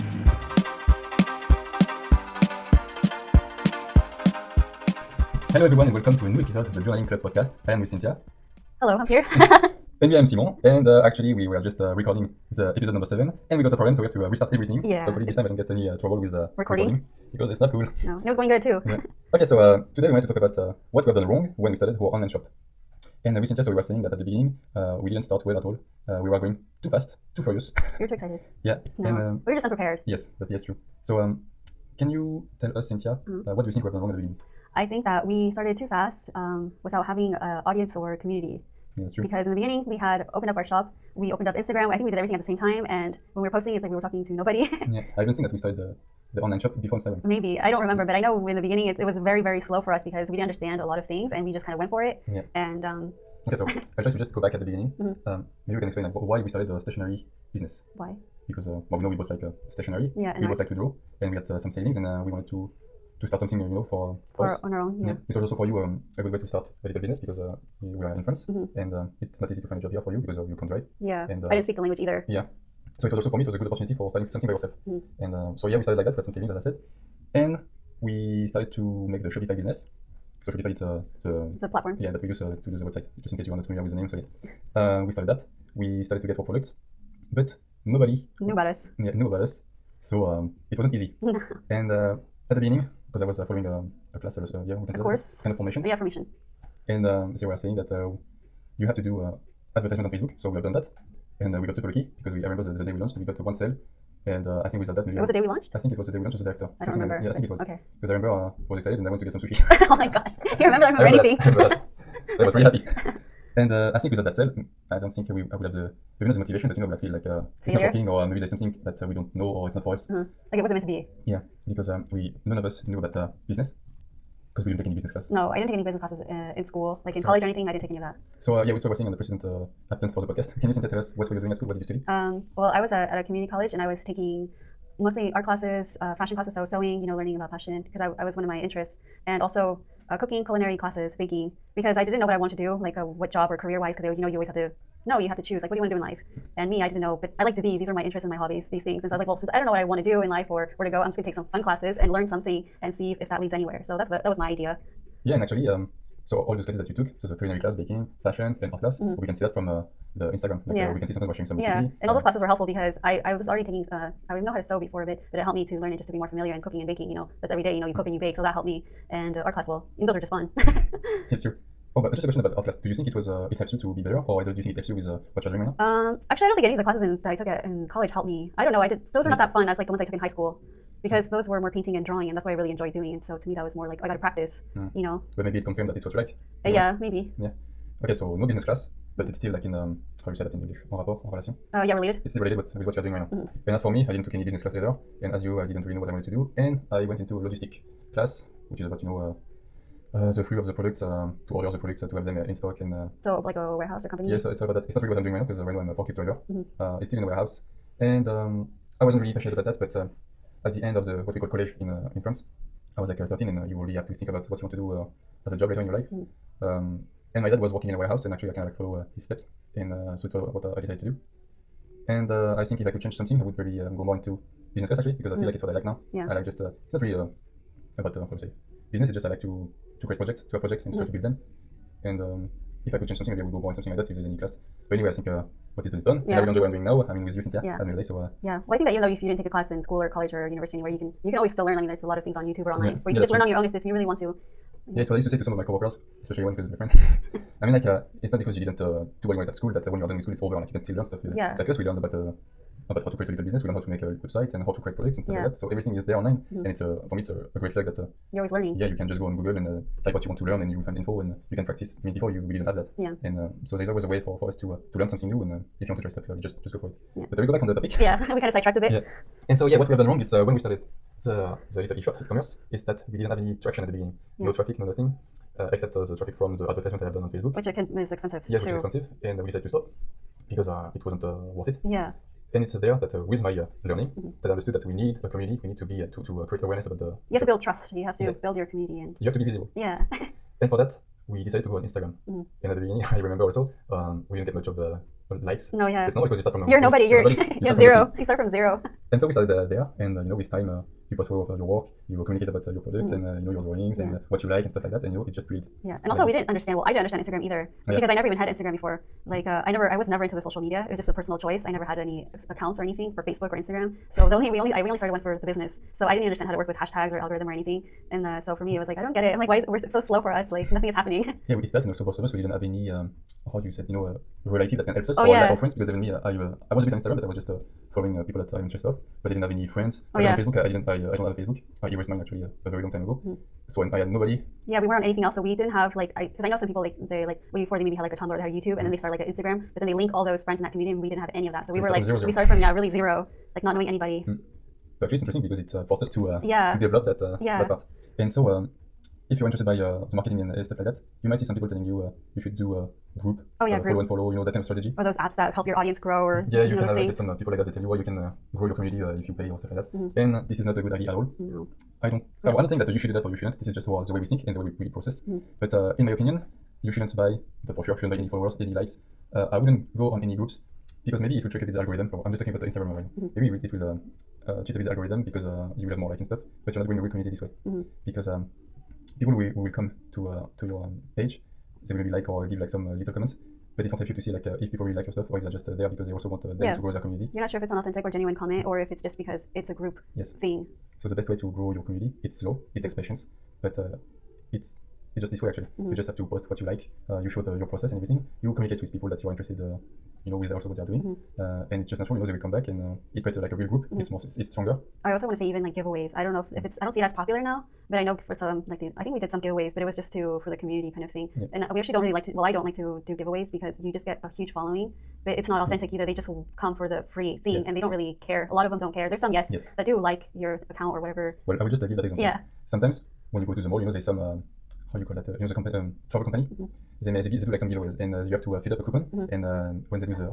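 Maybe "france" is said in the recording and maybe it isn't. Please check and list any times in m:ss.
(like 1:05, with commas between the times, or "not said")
1:08, 3:32.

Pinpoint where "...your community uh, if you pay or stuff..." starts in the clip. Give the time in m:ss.
5:58.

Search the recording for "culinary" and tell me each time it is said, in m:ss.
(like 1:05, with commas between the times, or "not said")
2:20, 2:37.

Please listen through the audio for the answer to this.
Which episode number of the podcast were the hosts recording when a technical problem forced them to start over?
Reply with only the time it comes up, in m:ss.
0:13.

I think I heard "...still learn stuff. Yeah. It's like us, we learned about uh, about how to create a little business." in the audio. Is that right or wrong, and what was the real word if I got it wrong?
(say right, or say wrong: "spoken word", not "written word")
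right.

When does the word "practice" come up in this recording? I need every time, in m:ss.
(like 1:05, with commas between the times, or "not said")
3:04, 4:21.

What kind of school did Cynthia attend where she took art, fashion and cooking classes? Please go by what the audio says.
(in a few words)
Community college.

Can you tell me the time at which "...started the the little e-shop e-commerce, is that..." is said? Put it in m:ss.
4:30.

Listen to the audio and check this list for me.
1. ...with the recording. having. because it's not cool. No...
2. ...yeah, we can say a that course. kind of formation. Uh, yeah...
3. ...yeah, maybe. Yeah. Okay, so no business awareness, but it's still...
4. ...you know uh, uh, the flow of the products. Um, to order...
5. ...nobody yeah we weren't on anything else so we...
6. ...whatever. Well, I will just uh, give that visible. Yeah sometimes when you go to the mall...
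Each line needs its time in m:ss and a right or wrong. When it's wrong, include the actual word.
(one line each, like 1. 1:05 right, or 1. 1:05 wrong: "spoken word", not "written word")
1. 0:16 wrong: "recording", not "having"
2. 1:34 right
3. 3:06 wrong: "class", not "awareness"
4. 3:19 right
5. 5:34 right
6. 7:00 wrong: "example", not "visible".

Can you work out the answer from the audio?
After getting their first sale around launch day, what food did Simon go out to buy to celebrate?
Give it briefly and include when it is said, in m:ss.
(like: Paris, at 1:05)
Sushi, at 1:49.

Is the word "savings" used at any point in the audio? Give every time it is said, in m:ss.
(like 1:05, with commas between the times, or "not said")
1:01, 1:16.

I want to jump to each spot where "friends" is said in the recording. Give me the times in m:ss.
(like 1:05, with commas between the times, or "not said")
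4:06, 5:25, 5:29, 5:40.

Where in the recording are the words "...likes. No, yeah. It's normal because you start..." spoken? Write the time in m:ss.
4:55.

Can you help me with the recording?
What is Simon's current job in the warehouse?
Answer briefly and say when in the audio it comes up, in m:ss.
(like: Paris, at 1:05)
Forklift driver, at 3:25.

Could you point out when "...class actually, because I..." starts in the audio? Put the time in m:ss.
3:44.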